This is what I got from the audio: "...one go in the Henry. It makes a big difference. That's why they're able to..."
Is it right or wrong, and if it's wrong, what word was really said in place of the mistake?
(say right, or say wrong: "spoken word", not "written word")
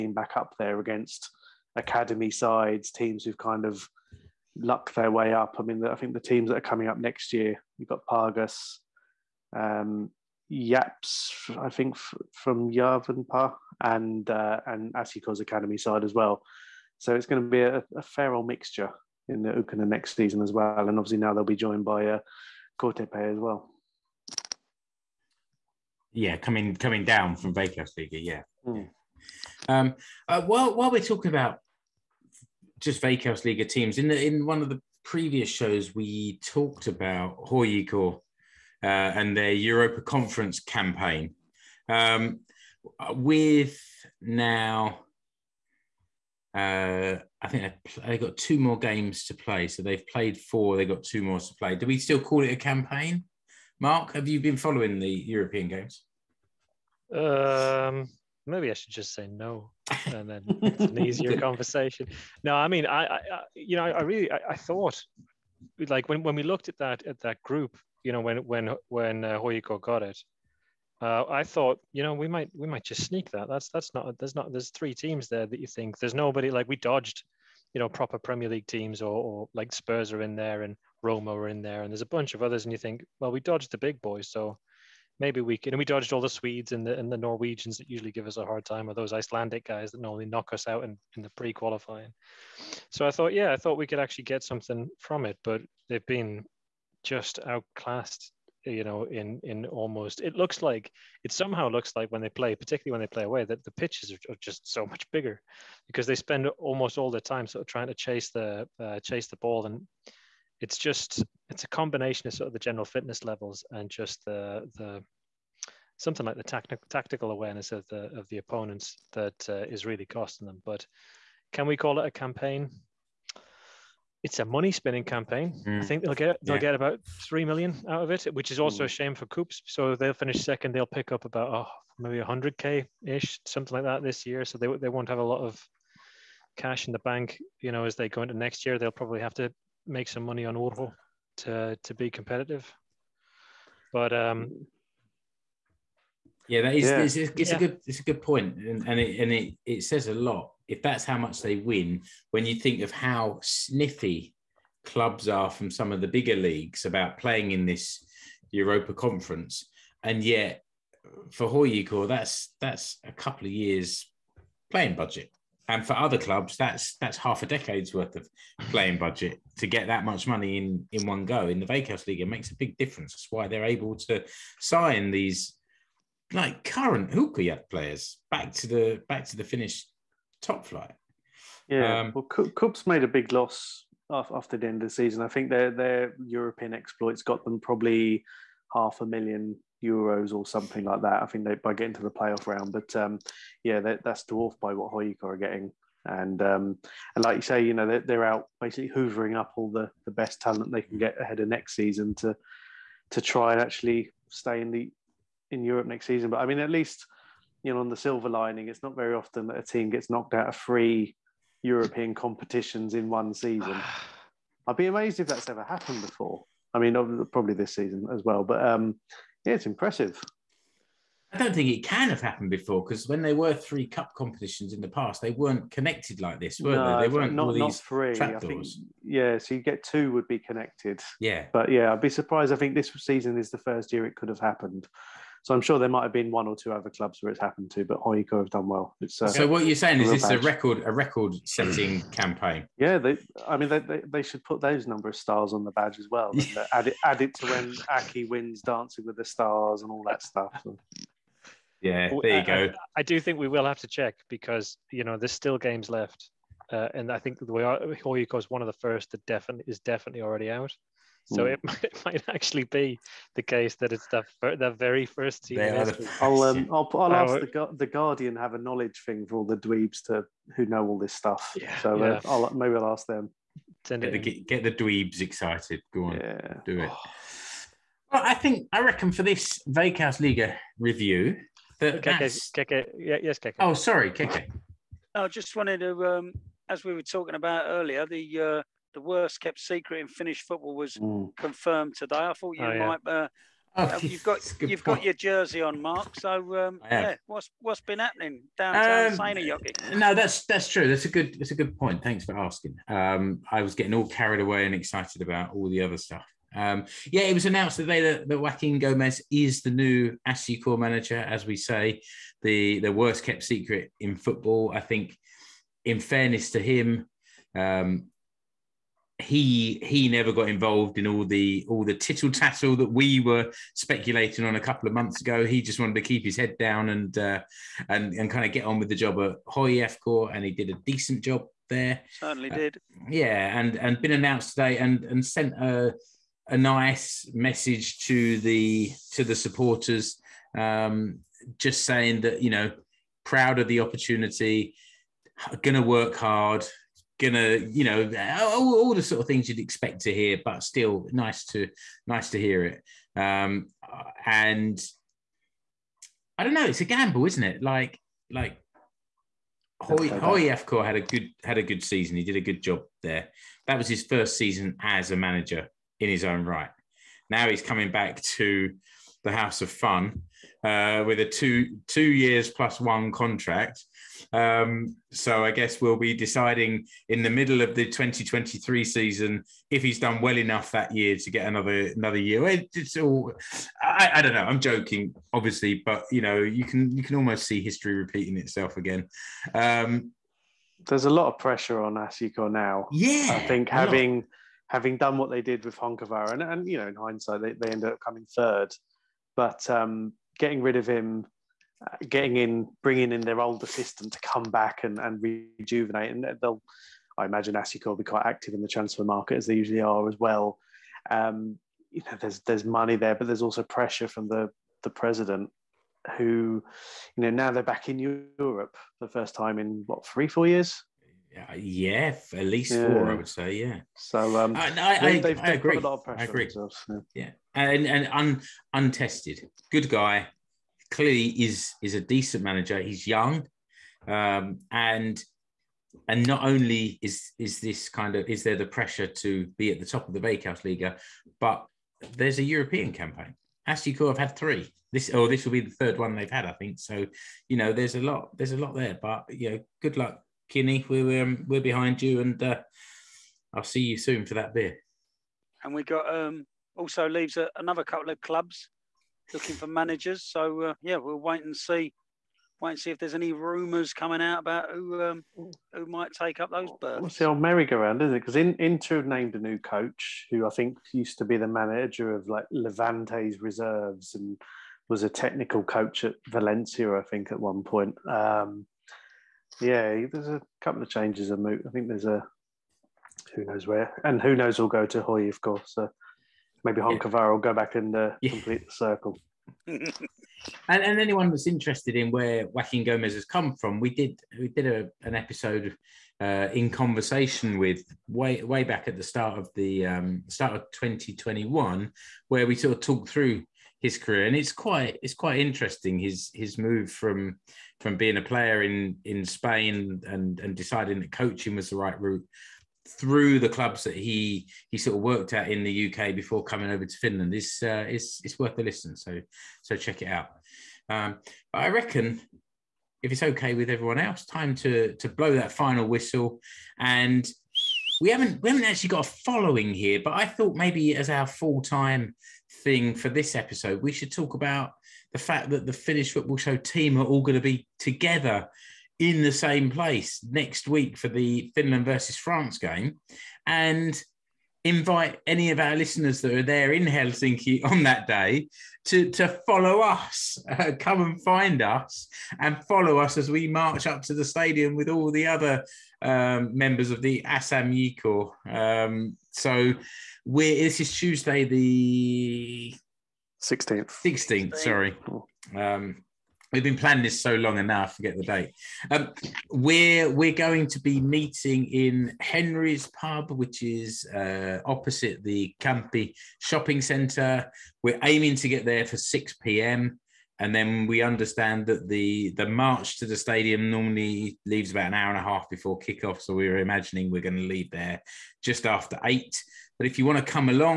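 wrong: "Veikkausliiga", not "Henry".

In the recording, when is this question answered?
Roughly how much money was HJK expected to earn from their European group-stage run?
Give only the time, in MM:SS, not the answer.
02:07.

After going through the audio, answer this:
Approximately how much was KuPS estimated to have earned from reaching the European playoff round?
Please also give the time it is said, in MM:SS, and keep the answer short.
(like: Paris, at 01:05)
half a million euros, at 03:08.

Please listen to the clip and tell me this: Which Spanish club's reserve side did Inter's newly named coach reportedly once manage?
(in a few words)
Levante.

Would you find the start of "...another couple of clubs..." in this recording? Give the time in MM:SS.
07:37.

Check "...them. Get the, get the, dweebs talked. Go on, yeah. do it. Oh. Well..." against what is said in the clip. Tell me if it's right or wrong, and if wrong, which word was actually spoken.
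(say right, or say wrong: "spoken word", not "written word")
wrong: "excited", not "talked".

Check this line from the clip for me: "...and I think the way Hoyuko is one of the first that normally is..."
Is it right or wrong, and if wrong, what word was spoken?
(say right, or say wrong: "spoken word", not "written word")
wrong: "definitely", not "normally".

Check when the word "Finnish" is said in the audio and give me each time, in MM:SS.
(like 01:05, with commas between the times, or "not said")
02:59, 04:50, 08:55.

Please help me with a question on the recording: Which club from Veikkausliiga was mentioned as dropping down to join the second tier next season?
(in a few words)
KTP.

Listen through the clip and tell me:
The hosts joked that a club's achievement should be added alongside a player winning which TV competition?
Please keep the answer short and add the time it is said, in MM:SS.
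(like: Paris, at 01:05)
Dancing with the Stars, at 04:08.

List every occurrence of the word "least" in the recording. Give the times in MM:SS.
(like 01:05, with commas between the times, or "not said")
03:26, 07:02.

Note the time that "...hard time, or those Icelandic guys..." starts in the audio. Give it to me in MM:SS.
01:28.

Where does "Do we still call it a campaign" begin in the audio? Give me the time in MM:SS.
00:51.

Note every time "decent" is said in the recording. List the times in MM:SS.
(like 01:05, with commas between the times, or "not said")
05:30, 07:11.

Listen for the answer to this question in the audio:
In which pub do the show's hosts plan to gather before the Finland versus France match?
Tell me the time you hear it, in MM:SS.
09:32.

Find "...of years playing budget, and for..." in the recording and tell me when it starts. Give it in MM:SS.
02:43.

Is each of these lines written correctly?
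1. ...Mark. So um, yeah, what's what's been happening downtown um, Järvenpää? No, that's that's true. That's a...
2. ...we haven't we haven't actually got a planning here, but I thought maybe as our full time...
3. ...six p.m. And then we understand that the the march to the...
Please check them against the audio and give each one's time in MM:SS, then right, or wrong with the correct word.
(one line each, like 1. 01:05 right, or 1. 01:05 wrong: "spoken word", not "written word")
1. 04:55 wrong: "Seinäjoki", not "Järvenpää"
2. 08:47 wrong: "following", not "planning"
3. 09:38 right.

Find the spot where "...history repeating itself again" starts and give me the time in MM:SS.
06:27.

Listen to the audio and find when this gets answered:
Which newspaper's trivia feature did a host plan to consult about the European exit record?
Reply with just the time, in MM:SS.
04:27.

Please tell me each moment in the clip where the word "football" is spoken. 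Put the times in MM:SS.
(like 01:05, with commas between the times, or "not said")
04:50, 05:14, 08:56.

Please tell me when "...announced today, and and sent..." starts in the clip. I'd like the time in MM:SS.
05:34.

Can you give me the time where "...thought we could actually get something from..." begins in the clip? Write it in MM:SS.
01:33.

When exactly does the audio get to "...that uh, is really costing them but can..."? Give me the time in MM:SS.
01:59.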